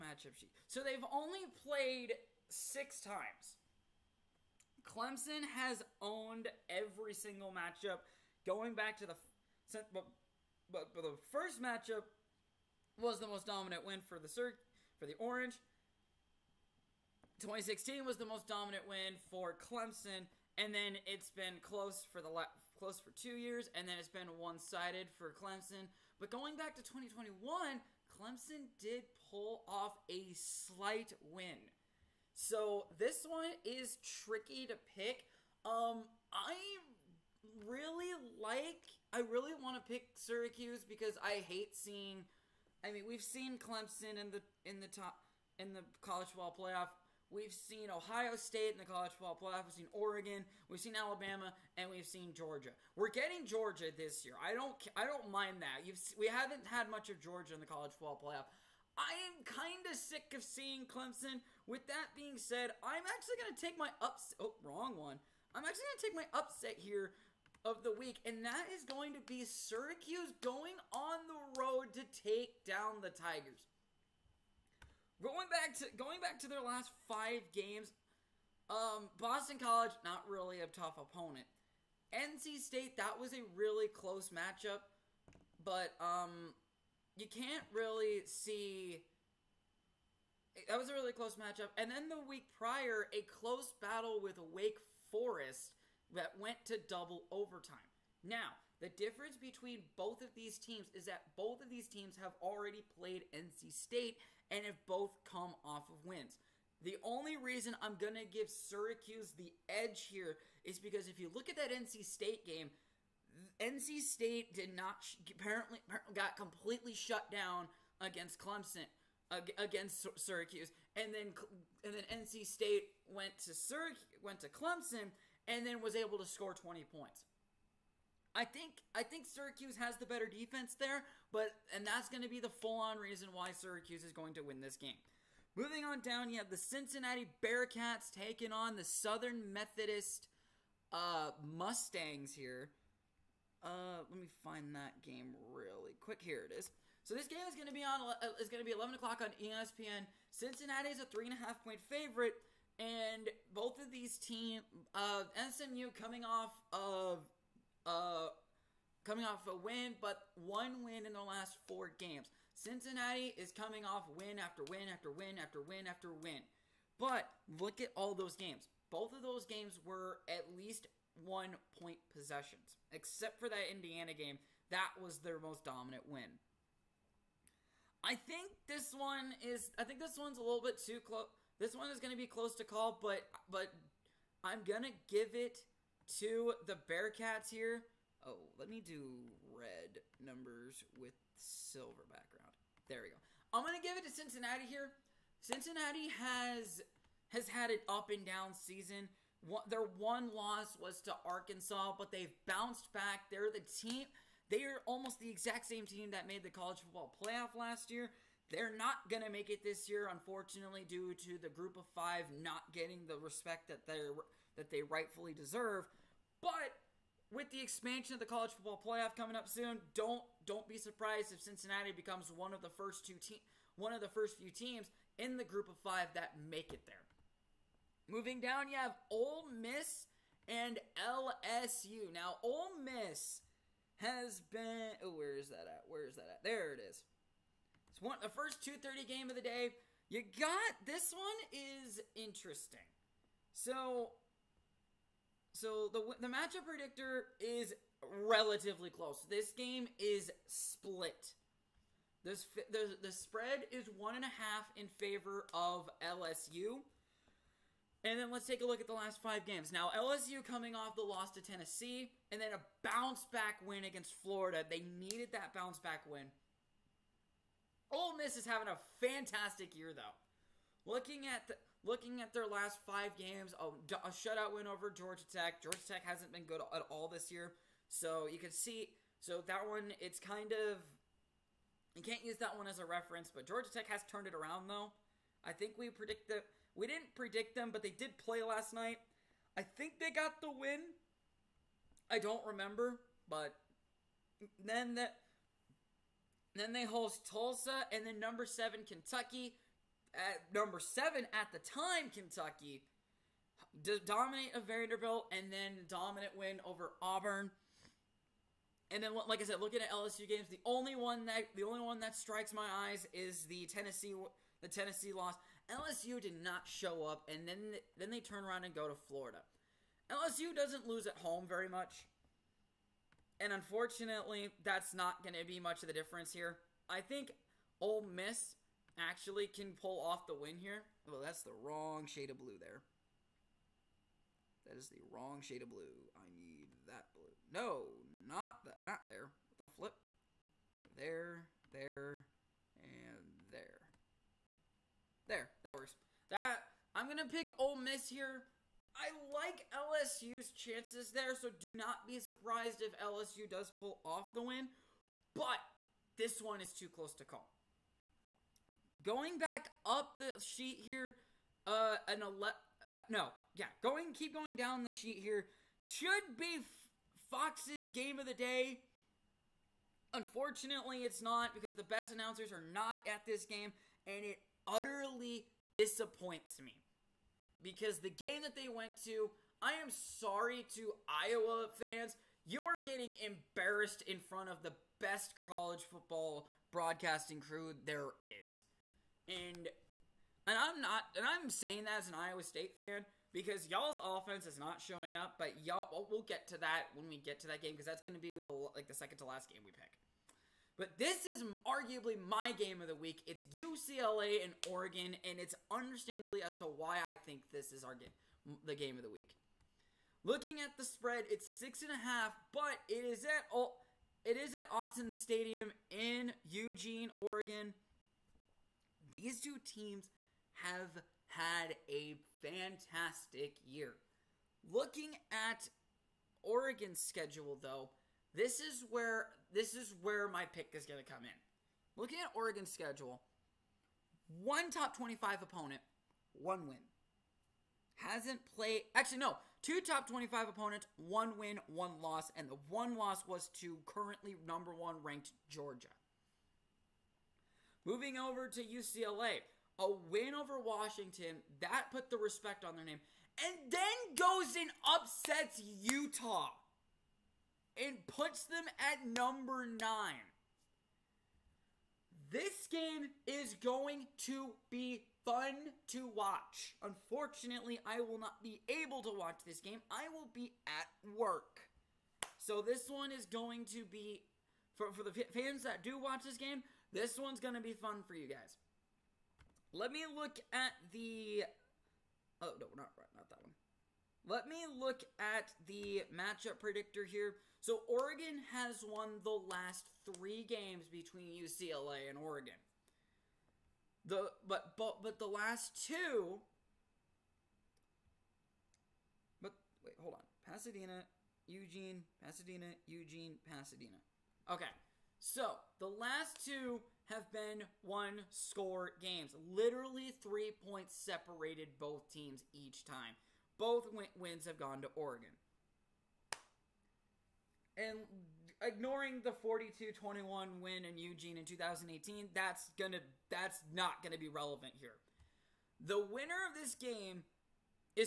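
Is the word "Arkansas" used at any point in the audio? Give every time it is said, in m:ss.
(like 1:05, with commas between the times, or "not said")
3:21.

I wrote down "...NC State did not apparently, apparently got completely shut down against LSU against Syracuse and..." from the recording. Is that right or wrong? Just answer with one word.
wrong.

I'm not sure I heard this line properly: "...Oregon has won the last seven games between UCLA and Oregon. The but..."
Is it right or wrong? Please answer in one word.
wrong.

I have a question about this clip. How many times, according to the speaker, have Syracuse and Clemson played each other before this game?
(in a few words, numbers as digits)
6.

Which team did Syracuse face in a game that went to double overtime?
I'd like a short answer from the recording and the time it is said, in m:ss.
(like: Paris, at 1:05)
Wake Forest, at 1:34.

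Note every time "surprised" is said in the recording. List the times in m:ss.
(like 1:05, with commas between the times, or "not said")
3:40, 5:52.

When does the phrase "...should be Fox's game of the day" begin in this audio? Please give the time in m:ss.
6:05.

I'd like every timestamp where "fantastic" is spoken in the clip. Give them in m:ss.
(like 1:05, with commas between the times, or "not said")
4:28, 7:02.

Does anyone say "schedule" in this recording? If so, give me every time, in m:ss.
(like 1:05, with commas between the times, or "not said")
7:06, 7:12.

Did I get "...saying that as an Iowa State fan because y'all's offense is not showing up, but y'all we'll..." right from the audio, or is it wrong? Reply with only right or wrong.
right.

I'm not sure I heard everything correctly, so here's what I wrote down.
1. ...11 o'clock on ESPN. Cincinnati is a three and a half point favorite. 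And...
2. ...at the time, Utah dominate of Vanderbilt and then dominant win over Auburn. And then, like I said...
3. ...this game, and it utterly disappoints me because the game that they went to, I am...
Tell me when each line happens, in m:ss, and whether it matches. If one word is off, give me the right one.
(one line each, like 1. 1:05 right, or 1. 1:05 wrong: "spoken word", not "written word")
1. 2:28 right
2. 5:01 wrong: "Kentucky", not "Utah"
3. 6:13 right.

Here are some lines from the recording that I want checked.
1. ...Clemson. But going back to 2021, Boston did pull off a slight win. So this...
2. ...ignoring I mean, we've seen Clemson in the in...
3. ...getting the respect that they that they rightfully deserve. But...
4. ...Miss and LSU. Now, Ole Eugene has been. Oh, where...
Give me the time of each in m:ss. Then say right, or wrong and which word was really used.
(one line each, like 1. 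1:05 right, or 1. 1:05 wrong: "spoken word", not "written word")
1. 0:25 wrong: "Clemson", not "Boston"
2. 0:41 wrong: "seeing", not "ignoring"
3. 3:32 right
4. 3:49 wrong: "Miss", not "Eugene".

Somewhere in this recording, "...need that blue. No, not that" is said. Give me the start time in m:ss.
5:36.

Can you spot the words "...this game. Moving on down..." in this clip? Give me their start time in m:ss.
2:14.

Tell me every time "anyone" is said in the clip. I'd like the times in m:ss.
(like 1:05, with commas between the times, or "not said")
not said.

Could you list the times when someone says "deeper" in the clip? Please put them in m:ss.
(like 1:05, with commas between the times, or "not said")
not said.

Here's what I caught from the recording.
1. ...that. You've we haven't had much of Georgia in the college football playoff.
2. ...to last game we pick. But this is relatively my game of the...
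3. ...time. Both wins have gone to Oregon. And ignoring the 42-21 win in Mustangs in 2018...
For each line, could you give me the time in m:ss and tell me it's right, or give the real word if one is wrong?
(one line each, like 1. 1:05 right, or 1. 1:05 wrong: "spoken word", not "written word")
1. 0:55 right
2. 6:39 wrong: "arguably", not "relatively"
3. 8:32 wrong: "Eugene", not "Mustangs".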